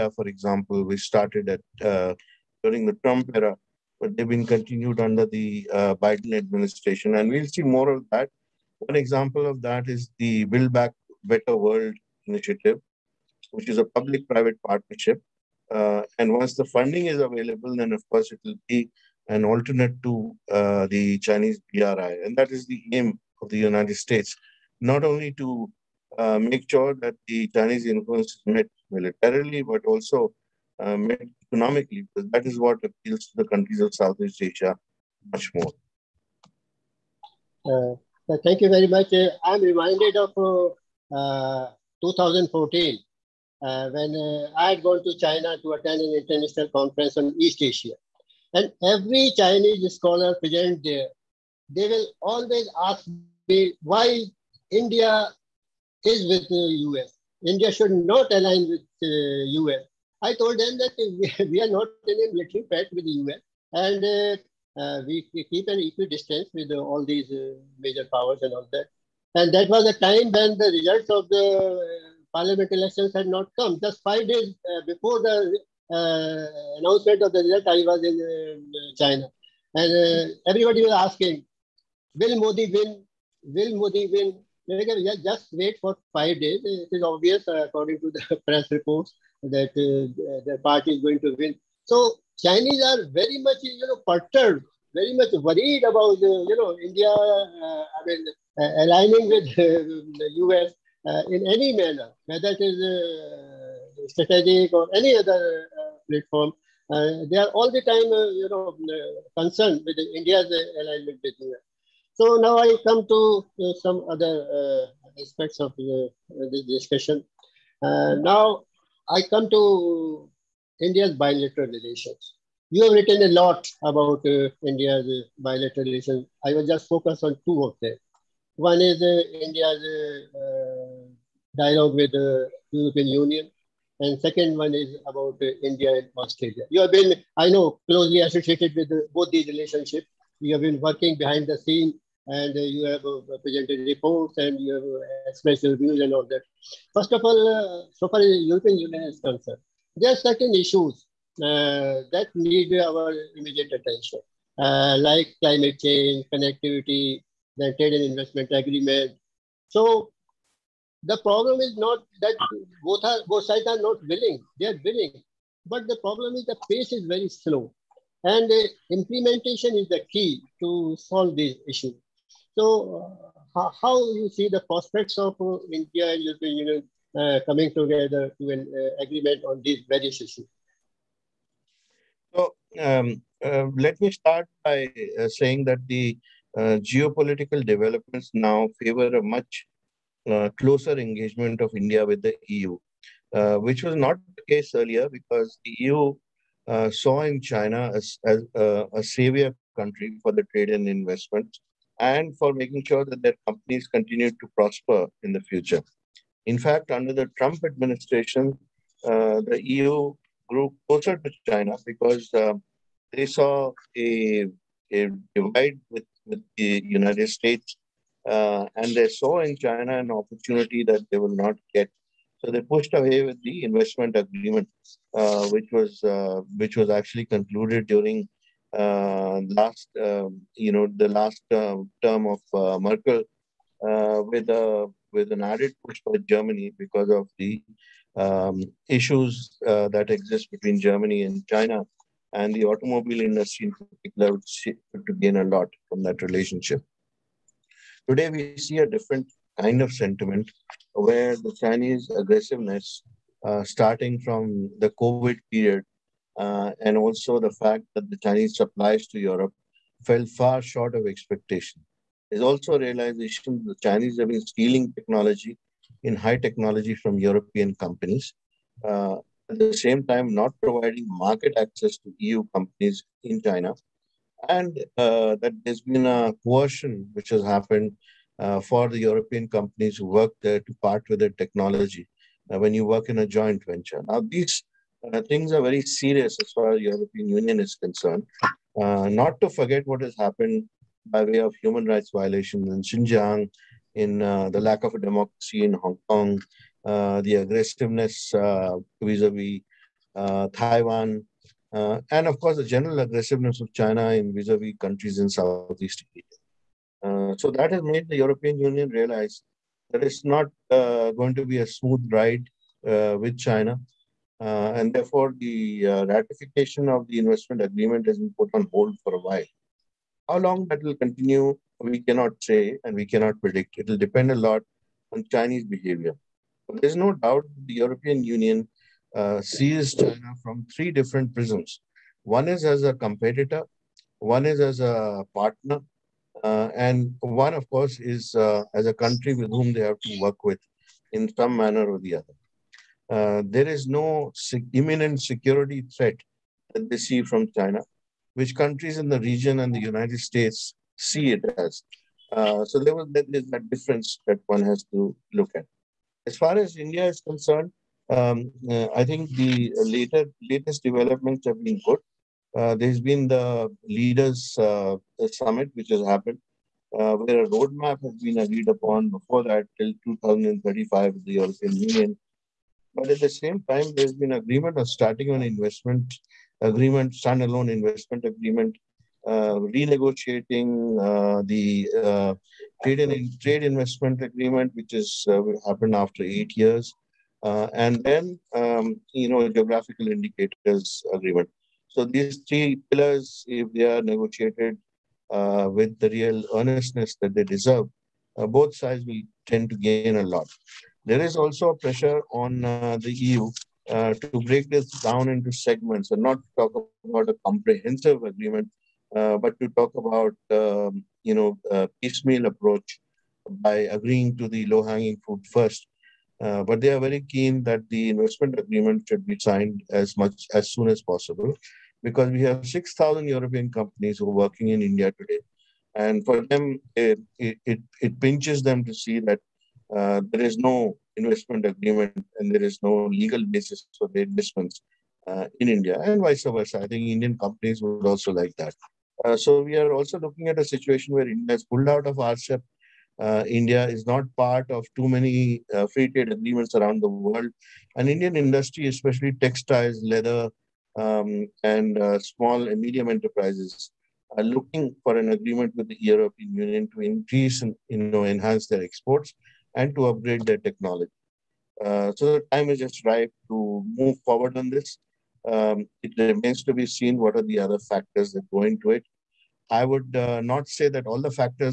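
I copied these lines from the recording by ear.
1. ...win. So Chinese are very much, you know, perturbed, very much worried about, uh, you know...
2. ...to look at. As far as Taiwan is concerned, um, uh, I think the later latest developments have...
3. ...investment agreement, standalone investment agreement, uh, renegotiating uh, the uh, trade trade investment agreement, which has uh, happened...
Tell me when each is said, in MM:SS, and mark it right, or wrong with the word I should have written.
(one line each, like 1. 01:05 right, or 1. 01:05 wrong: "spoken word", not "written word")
1. 01:31 right
2. 05:54 wrong: "India", not "Taiwan"
3. 06:15 right.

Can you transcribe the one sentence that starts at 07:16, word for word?
I think Indian companies would also like that.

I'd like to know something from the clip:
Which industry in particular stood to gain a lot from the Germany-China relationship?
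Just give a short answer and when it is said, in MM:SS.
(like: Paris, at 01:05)
automobile industry, at 04:02.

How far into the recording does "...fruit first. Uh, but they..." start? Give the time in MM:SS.
06:55.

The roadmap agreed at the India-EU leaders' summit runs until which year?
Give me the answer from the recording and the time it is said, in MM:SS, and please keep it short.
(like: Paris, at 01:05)
2035, at 06:10.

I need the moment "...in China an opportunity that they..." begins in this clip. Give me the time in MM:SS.
03:39.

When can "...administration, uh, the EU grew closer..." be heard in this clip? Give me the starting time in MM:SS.
03:27.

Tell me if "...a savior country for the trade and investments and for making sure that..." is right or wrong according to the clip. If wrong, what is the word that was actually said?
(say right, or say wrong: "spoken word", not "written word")
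right.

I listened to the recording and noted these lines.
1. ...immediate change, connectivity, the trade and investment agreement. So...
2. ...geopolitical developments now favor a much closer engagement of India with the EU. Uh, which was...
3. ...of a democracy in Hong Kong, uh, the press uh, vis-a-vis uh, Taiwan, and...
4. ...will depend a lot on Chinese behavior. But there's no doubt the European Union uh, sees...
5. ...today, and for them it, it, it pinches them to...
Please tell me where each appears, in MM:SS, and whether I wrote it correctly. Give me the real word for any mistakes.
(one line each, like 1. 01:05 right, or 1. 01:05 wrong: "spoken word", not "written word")
1. 02:35 wrong: "climate", not "immediate"
2. 03:06 right
3. 04:54 wrong: "aggressiveness", not "press"
4. 05:23 right
5. 07:05 right.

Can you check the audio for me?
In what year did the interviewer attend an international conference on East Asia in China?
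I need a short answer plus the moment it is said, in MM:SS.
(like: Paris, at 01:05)
2014, at 00:42.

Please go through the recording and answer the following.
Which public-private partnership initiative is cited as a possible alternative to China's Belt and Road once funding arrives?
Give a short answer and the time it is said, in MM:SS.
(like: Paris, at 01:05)
Build Back Better World, at 00:10.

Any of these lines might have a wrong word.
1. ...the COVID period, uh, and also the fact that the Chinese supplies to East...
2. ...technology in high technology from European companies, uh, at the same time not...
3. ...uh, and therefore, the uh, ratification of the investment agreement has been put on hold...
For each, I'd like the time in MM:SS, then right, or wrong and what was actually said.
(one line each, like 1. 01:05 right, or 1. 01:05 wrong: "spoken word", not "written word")
1. 04:14 wrong: "Europe", not "East"
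2. 04:24 right
3. 05:14 right.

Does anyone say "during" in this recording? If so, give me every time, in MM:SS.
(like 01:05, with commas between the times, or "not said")
00:02, 03:47.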